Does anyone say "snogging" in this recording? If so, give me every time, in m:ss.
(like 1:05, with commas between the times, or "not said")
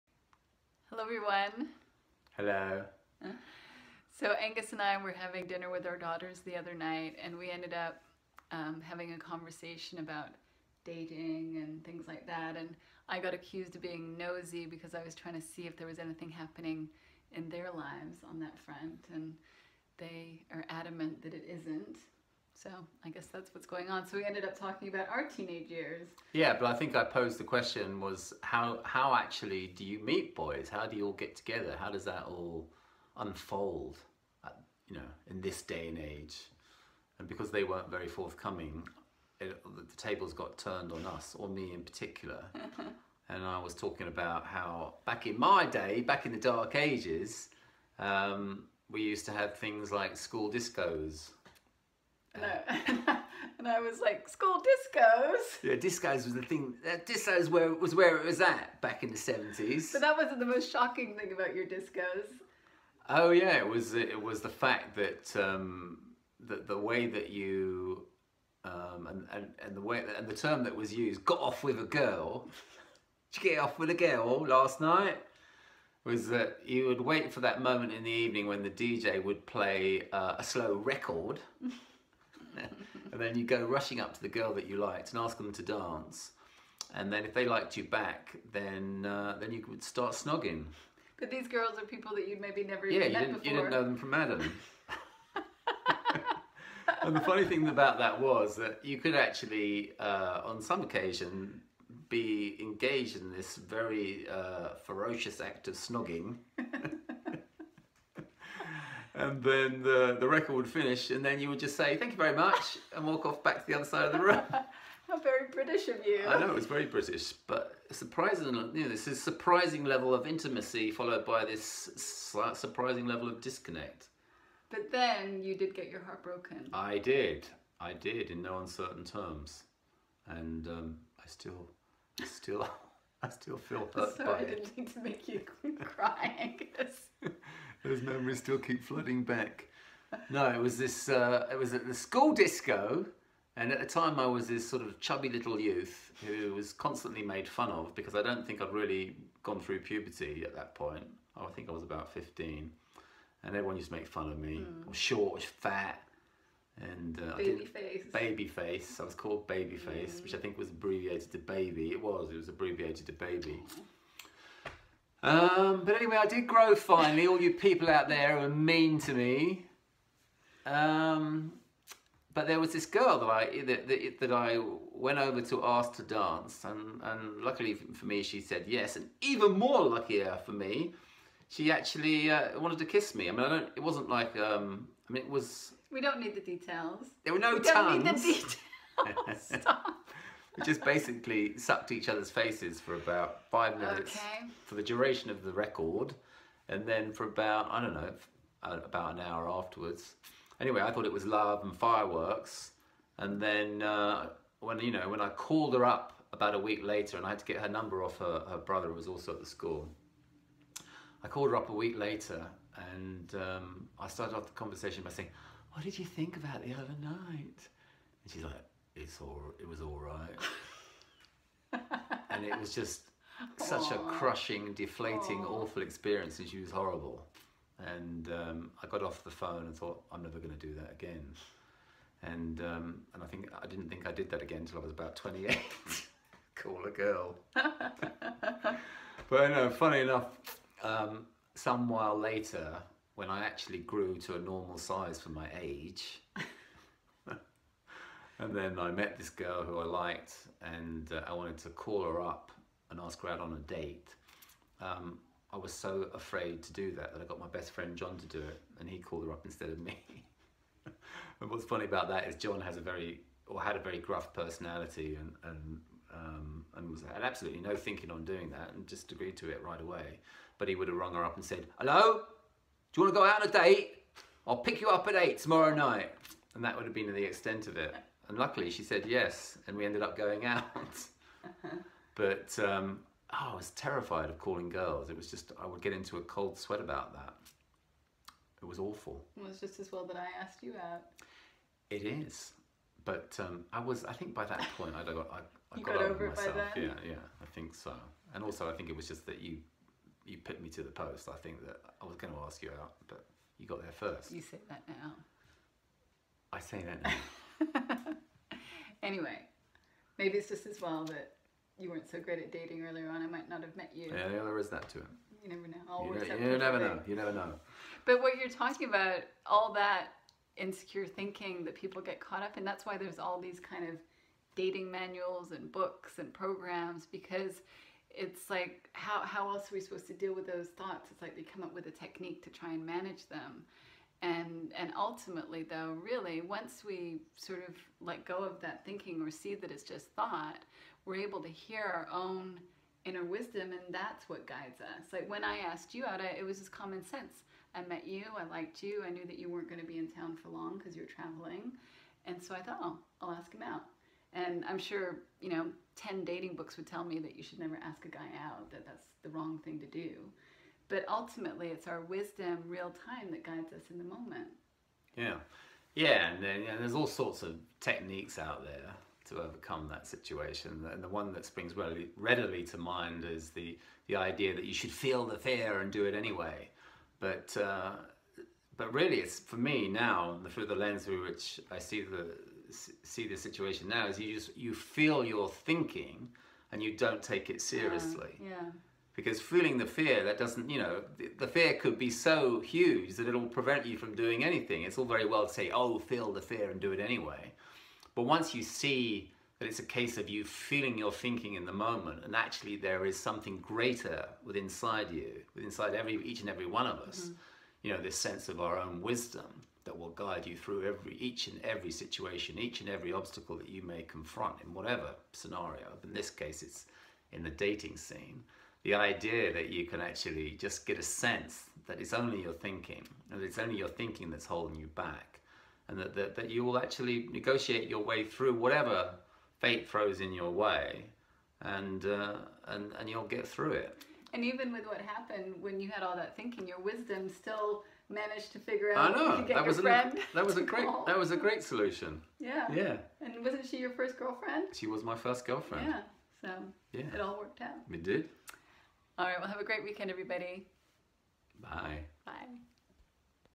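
1:30, 1:45.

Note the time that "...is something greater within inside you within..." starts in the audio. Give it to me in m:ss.
6:43.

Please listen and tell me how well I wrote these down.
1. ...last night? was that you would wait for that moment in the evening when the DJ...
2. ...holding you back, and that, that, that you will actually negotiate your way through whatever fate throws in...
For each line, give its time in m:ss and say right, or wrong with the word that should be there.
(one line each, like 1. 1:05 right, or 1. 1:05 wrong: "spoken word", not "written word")
1. 1:14 right
2. 7:04 right.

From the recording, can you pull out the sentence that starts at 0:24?
So we ended up talking about our teenage years.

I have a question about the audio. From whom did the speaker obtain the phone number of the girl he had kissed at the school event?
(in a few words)
her brother.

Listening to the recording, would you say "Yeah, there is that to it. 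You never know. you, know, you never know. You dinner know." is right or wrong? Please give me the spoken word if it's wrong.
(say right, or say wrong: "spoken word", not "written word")
wrong: "never", not "dinner".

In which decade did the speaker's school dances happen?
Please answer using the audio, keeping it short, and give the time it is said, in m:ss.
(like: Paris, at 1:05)
the seventies, at 0:59.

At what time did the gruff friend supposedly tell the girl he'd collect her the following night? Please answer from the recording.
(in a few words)
8.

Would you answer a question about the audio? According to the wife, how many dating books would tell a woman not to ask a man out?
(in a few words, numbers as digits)
10.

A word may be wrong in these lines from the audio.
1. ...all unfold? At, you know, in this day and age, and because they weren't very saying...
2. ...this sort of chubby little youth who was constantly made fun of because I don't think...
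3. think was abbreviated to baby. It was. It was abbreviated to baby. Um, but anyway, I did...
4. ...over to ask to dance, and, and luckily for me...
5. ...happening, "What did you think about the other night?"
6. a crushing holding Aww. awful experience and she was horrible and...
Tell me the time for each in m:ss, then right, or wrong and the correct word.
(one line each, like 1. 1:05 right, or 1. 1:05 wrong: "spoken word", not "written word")
1. 0:32 wrong: "forthcoming", not "saying"
2. 2:24 right
3. 2:40 right
4. 2:55 right
5. 3:35 wrong: "saying", not "happening"
6. 3:43 wrong: "deflating", not "holding".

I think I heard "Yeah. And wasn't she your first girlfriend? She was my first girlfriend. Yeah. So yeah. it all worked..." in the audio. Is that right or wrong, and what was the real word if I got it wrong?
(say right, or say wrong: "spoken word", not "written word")
right.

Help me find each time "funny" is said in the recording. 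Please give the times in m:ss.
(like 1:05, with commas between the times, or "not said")
1:37, 3:59, 4:21.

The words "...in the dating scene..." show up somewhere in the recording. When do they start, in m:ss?
6:57.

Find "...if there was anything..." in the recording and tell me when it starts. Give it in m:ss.
0:15.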